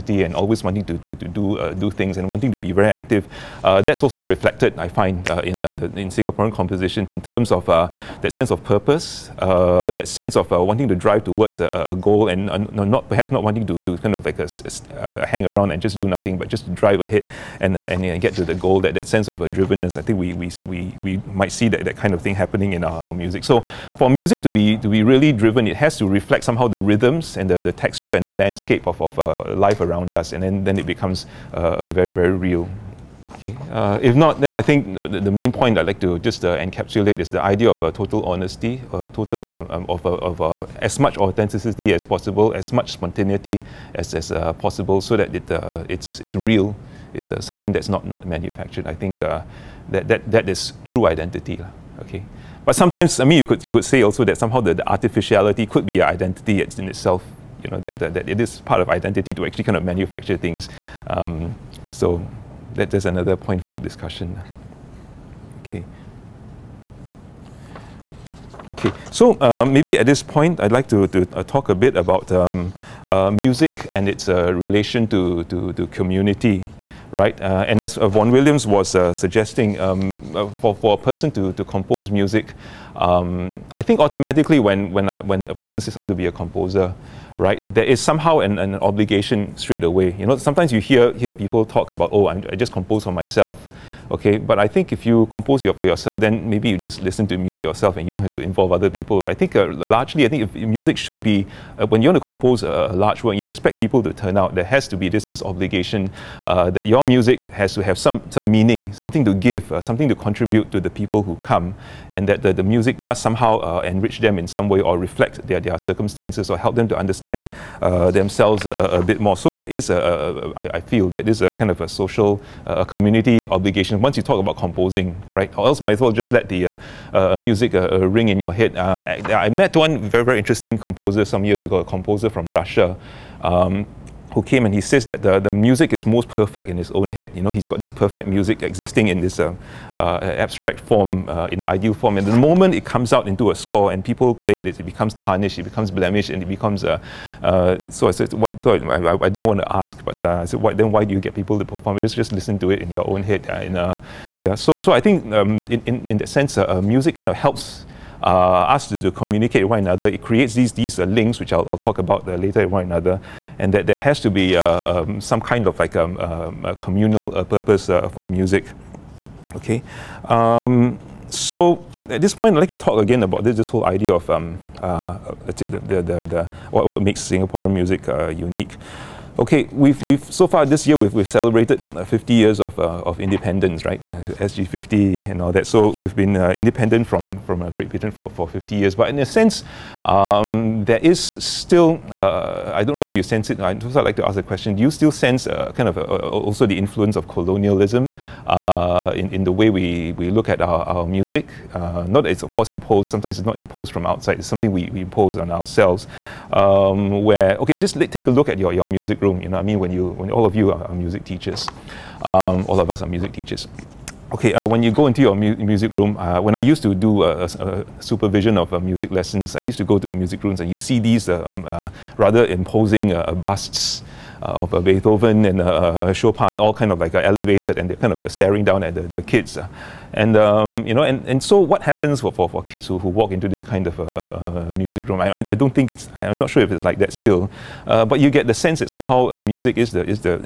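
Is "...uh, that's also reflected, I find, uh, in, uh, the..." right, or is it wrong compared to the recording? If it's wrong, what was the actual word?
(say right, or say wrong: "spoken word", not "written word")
right.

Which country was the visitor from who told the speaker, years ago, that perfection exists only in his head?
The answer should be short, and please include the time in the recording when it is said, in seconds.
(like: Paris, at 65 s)
Russia, at 132 s.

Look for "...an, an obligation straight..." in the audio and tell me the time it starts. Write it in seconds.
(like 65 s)
88 s.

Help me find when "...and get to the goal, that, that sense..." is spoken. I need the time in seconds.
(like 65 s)
17 s.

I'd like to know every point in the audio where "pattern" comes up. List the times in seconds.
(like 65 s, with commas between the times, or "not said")
not said.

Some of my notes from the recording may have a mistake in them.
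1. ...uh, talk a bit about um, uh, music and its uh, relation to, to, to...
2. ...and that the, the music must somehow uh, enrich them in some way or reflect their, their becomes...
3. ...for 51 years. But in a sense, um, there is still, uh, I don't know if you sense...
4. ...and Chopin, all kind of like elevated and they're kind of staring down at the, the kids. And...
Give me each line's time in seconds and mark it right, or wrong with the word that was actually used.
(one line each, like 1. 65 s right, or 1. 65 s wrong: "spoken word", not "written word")
1. 71 s right
2. 112 s wrong: "circumstances", not "becomes"
3. 188 s wrong: "50", not "51"
4. 225 s right.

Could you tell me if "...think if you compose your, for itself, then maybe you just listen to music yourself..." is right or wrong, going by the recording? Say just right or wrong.
wrong.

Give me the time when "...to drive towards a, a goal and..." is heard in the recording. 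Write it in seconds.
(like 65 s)
10 s.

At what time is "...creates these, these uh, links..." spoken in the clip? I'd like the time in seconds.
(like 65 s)
160 s.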